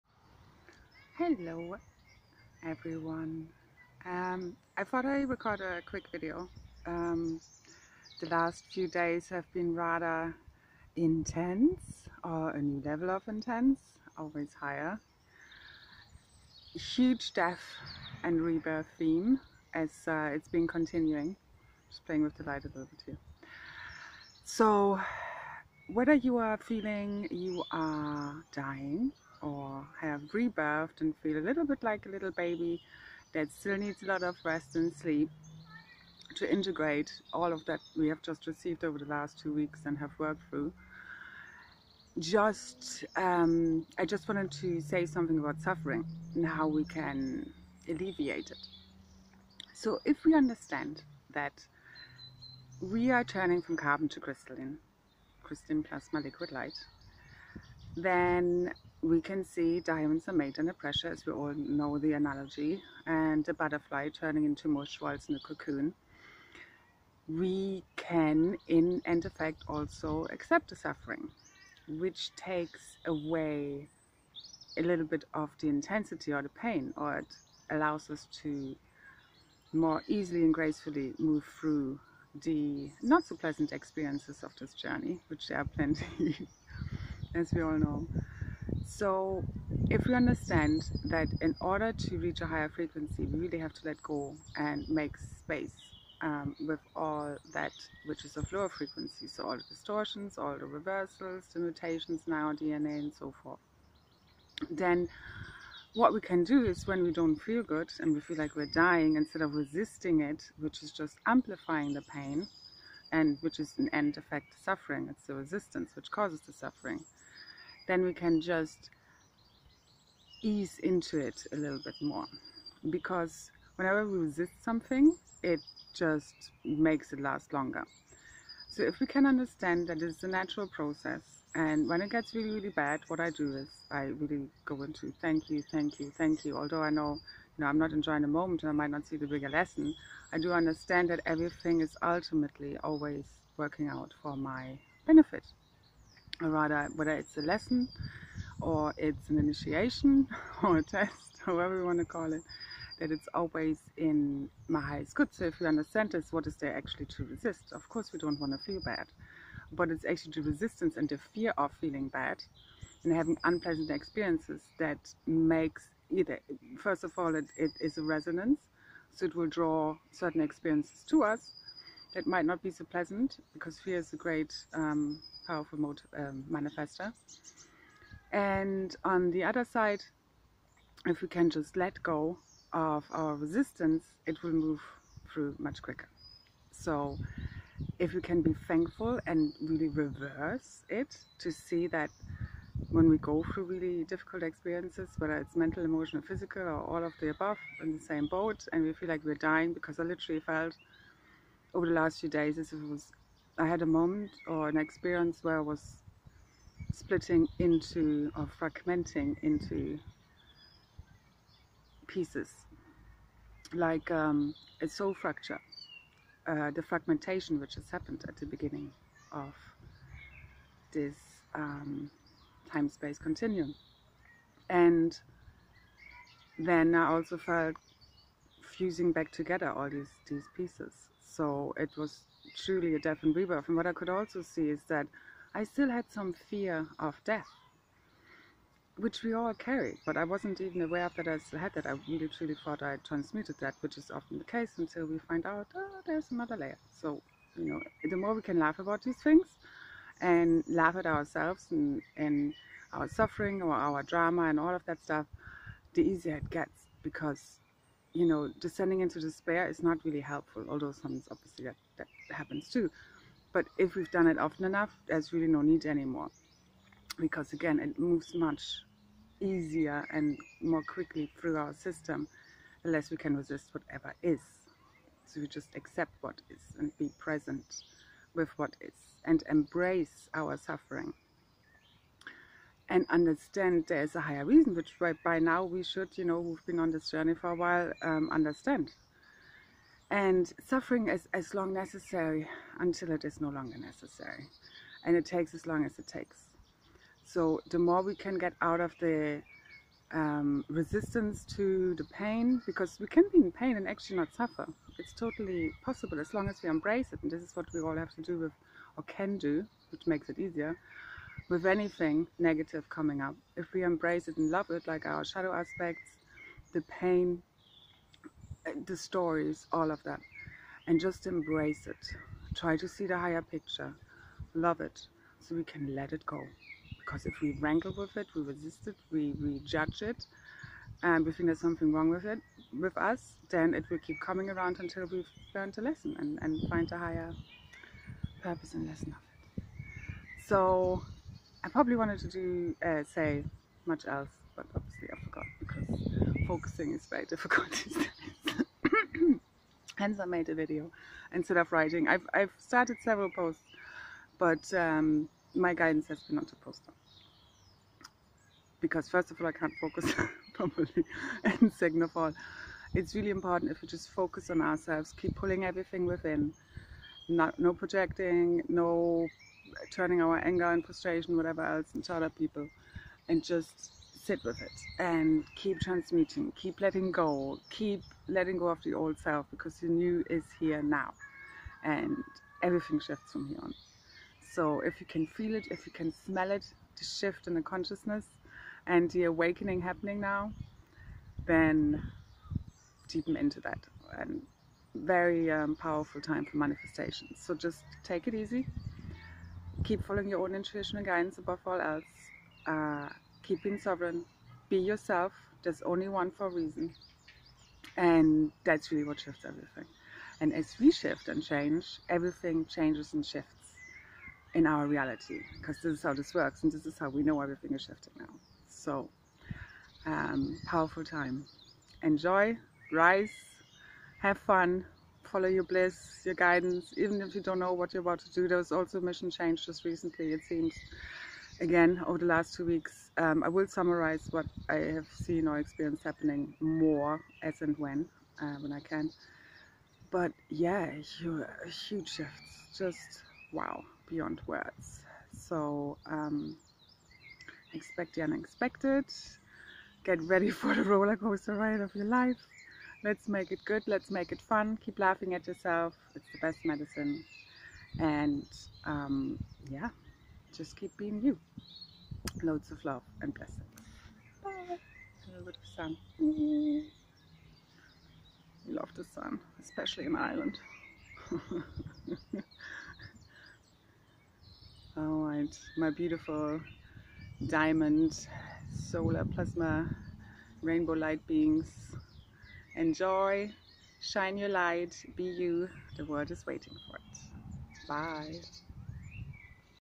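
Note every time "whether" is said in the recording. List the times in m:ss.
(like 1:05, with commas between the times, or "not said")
0:25, 2:26, 3:15.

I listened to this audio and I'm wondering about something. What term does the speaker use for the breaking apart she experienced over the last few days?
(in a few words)
soul fracture.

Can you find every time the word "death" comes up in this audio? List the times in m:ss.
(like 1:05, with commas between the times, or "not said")
0:17, 3:52, 3:57.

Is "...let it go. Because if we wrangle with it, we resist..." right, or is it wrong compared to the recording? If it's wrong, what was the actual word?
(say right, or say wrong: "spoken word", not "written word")
right.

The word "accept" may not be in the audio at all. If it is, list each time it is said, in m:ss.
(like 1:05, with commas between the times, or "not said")
1:10, 4:35.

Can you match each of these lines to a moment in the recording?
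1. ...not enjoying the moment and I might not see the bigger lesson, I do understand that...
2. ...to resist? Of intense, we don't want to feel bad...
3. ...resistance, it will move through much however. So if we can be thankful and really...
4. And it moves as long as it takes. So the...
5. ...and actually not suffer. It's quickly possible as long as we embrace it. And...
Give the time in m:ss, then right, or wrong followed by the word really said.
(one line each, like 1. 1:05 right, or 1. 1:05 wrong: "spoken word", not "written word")
1. 2:17 right
2. 2:37 wrong: "course", not "intense"
3. 3:03 wrong: "quicker", not "however"
4. 4:55 wrong: "takes", not "moves"
5. 5:03 wrong: "totally", not "quickly".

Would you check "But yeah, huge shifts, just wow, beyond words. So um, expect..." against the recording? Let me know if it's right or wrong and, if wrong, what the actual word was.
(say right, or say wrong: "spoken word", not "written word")
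right.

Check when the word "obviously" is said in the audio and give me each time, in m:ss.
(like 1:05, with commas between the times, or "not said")
4:21, 5:44.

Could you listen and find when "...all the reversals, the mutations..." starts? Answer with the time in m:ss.
1:40.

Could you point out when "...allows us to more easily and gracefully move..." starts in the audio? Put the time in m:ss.
1:17.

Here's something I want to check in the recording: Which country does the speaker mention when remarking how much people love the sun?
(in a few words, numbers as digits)
Ireland.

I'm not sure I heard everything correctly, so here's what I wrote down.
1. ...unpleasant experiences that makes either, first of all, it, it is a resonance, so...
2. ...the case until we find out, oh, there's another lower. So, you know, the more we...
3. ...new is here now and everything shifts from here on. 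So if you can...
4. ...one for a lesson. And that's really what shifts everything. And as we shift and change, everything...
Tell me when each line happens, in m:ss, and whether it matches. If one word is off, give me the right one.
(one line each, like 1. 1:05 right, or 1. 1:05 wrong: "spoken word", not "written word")
1. 2:43 right
2. 4:04 wrong: "layer", not "lower"
3. 6:19 right
4. 6:46 wrong: "reason", not "lesson".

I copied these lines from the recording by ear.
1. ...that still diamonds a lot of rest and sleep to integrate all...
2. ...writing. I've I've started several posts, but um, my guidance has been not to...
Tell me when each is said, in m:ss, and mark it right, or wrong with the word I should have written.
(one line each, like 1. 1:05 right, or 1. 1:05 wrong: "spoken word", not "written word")
1. 0:33 wrong: "needs", not "diamonds"
2. 5:51 right.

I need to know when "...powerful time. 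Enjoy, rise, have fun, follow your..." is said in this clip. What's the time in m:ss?
7:00.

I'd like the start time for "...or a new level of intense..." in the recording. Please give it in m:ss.
0:12.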